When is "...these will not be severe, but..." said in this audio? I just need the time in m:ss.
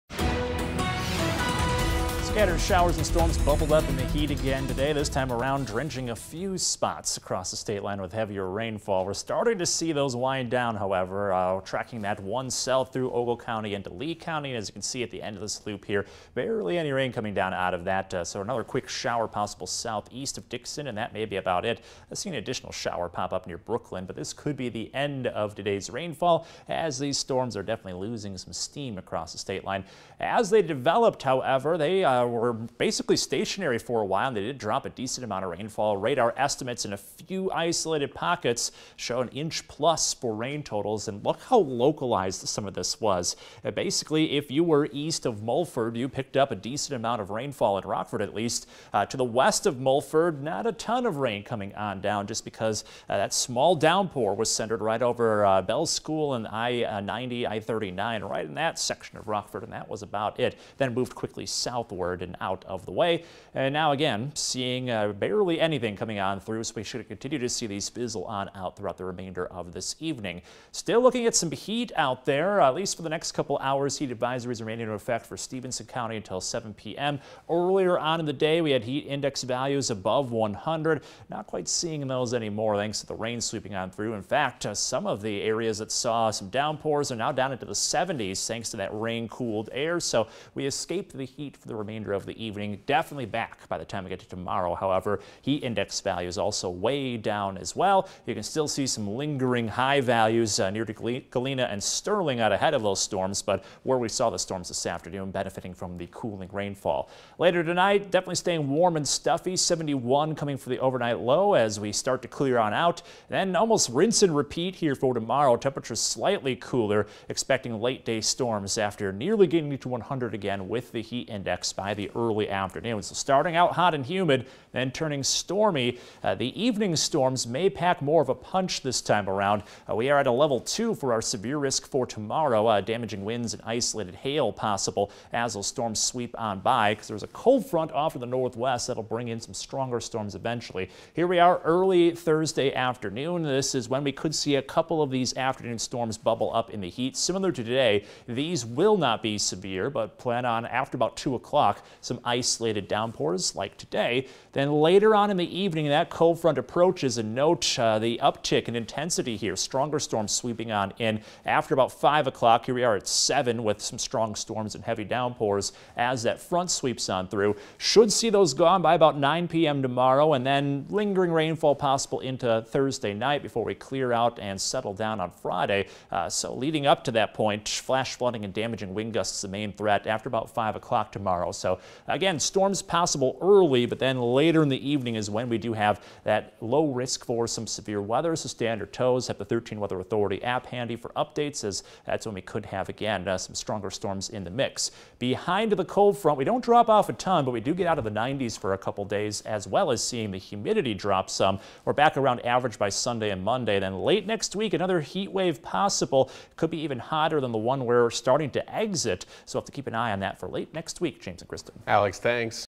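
2:28.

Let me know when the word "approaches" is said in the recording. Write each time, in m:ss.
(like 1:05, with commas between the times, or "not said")
2:36.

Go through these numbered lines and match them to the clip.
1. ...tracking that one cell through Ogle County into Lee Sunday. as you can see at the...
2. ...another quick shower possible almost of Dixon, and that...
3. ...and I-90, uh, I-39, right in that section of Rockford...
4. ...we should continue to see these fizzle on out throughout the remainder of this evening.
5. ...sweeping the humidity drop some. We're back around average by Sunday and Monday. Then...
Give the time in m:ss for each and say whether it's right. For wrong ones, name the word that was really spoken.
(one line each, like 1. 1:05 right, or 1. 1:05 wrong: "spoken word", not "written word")
1. 0:11 wrong: "County", not "Sunday"
2. 0:18 wrong: "southeast", not "almost"
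3. 0:56 right
4. 1:06 right
5. 3:20 wrong: "seeing", not "sweeping".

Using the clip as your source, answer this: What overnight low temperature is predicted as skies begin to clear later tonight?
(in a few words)
71.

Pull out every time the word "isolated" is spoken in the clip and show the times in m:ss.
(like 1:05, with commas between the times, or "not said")
0:37, 2:13, 2:32.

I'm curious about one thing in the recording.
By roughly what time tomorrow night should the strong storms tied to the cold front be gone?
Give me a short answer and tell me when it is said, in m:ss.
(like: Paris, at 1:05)
9 p.m., at 2:49.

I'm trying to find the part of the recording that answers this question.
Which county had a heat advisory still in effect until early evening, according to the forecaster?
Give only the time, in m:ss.
1:15.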